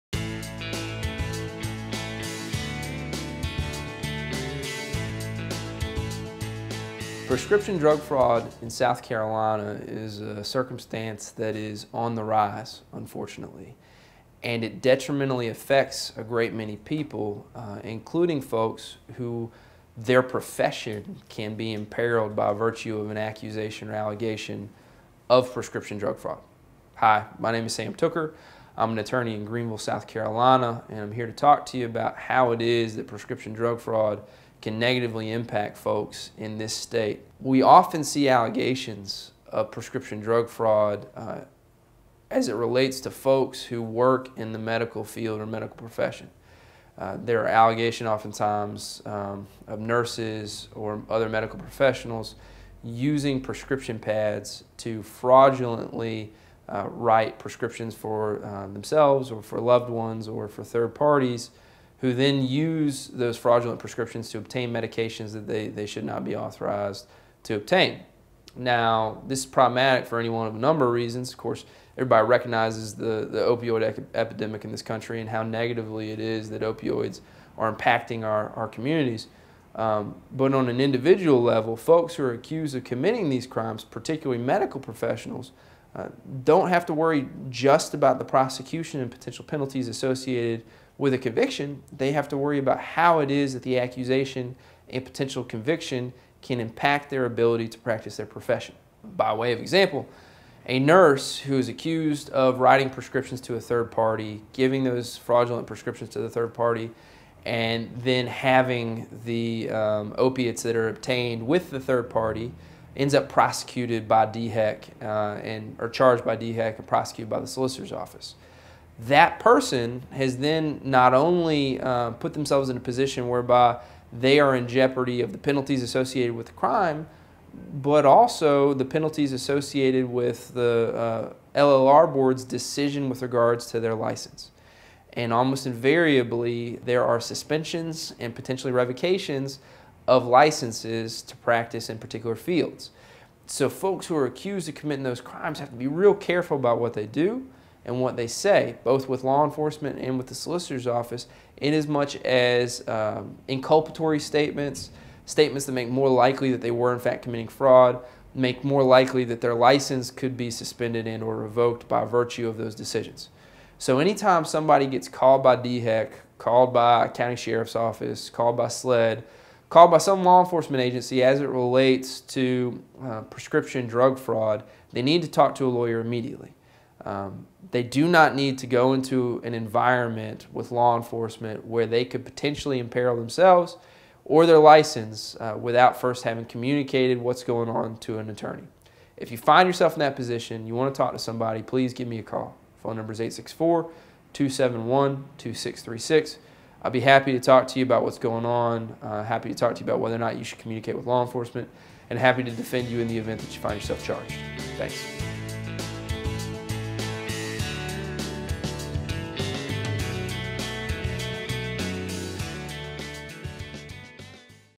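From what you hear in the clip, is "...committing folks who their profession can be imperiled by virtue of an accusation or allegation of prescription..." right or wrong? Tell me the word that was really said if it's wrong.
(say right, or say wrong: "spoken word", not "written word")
wrong: "including", not "committing".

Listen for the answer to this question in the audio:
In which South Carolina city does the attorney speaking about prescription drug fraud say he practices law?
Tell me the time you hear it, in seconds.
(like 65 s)
29 s.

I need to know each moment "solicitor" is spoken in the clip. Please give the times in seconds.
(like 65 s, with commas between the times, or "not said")
117 s, 150 s.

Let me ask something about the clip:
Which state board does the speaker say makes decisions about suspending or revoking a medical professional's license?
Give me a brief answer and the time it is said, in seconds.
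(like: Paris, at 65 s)
LLR board, at 131 s.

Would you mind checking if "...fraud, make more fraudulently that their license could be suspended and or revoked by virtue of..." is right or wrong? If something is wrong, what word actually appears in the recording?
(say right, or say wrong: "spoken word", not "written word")
wrong: "likely", not "fraudulently".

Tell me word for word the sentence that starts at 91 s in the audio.
They have to worry about how it is that the accusation and potential conviction can impact their ability to practice their profession.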